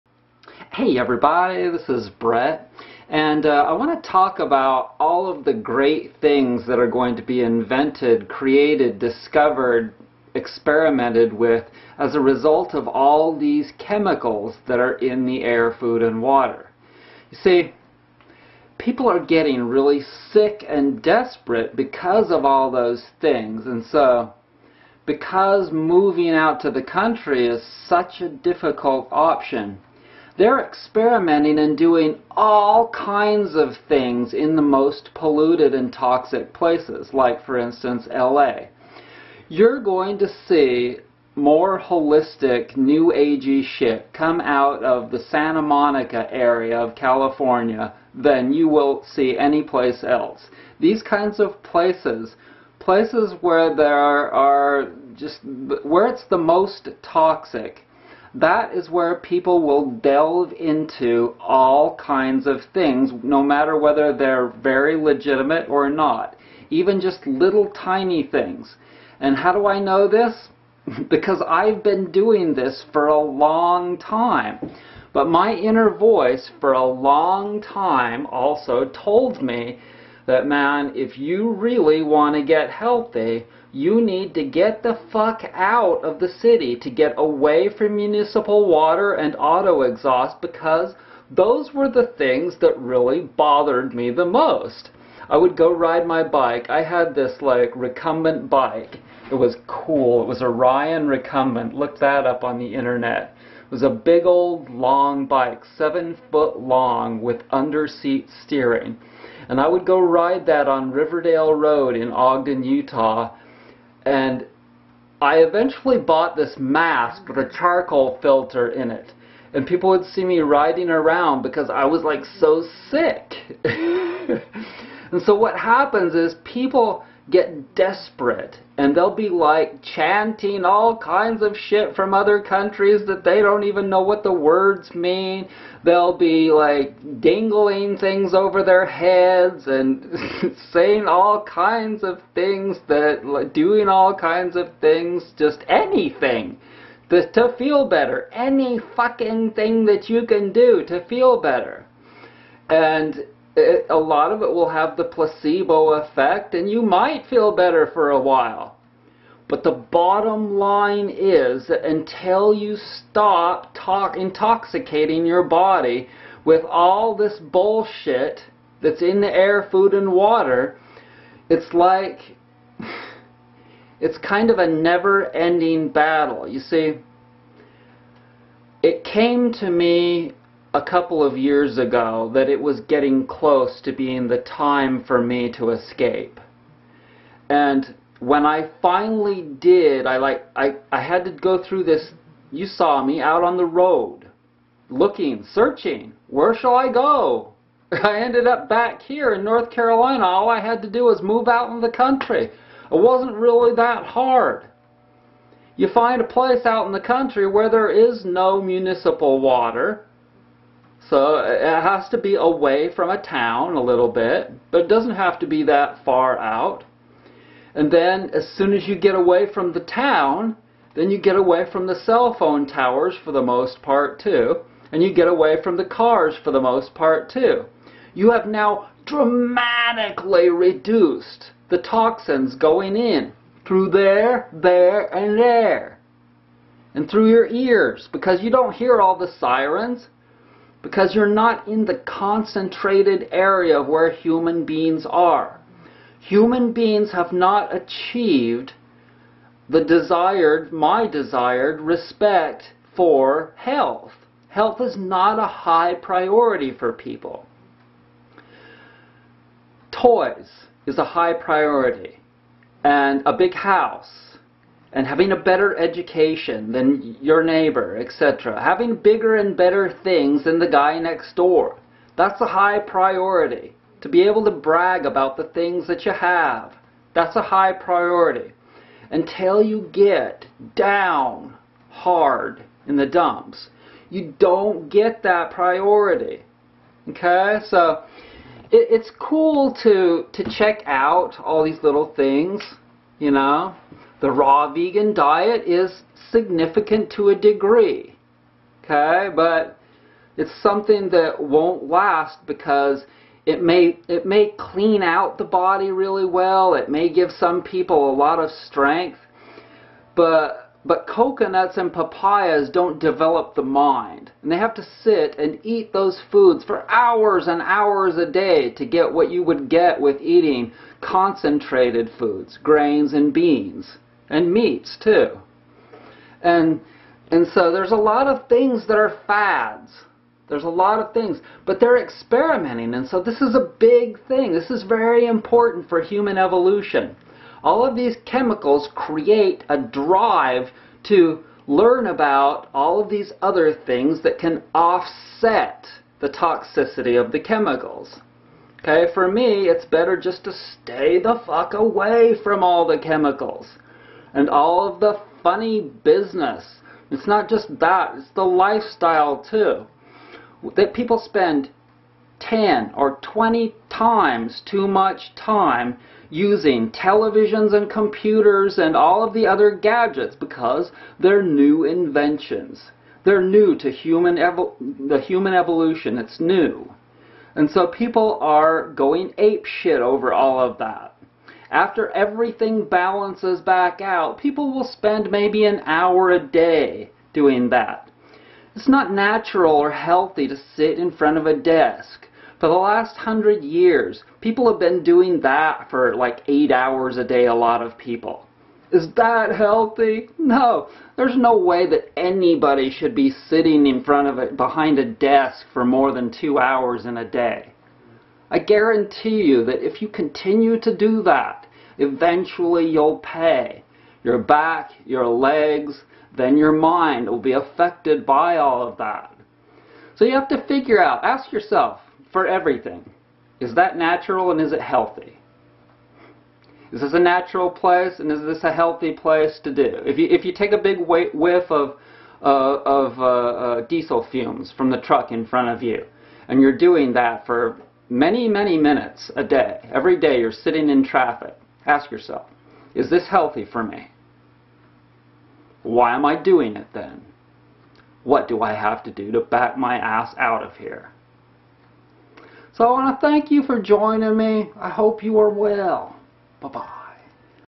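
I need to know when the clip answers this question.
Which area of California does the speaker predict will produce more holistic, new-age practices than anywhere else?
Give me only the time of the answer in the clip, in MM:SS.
00:45.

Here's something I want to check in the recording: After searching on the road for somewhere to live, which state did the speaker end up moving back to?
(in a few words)
North Carolina.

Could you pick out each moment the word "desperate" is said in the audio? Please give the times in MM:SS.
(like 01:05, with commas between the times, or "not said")
00:21, 02:07.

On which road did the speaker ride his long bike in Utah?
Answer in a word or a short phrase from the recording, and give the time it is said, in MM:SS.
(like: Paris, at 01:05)
Riverdale Road, at 01:50.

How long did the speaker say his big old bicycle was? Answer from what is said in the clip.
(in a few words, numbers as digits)
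7 foot.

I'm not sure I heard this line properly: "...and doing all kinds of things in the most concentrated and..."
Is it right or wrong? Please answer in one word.
wrong.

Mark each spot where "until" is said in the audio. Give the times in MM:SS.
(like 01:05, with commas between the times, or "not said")
02:41, 04:39.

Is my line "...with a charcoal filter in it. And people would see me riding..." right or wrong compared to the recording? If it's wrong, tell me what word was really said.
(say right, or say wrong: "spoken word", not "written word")
right.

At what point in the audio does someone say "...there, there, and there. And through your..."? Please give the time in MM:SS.
03:53.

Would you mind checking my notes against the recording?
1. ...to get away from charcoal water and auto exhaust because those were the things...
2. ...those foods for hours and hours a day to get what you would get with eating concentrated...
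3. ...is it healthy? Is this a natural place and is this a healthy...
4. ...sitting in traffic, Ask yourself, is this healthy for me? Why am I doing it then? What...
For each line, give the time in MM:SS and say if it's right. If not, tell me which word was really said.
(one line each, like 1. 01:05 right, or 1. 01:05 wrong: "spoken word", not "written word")
1. 01:26 wrong: "municipal", not "charcoal"
2. 05:15 right
3. 07:04 right
4. 07:20 right.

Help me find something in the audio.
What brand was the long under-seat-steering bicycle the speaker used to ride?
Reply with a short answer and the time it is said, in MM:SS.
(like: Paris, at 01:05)
Ryan, at 01:40.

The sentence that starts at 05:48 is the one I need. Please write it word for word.
Okay, for me, it's better just to stay the fuck away from all the chemicals and all of the funny business.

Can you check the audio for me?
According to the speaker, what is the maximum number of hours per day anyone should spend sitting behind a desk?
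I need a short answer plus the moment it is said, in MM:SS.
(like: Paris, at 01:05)
2 hours, at 06:46.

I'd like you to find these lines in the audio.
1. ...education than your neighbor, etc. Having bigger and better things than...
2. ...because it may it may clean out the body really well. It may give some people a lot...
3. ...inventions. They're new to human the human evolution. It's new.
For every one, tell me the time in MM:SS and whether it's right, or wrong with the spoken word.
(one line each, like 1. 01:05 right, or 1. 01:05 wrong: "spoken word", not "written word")
1. 04:25 right
2. 05:02 right
3. 06:11 right.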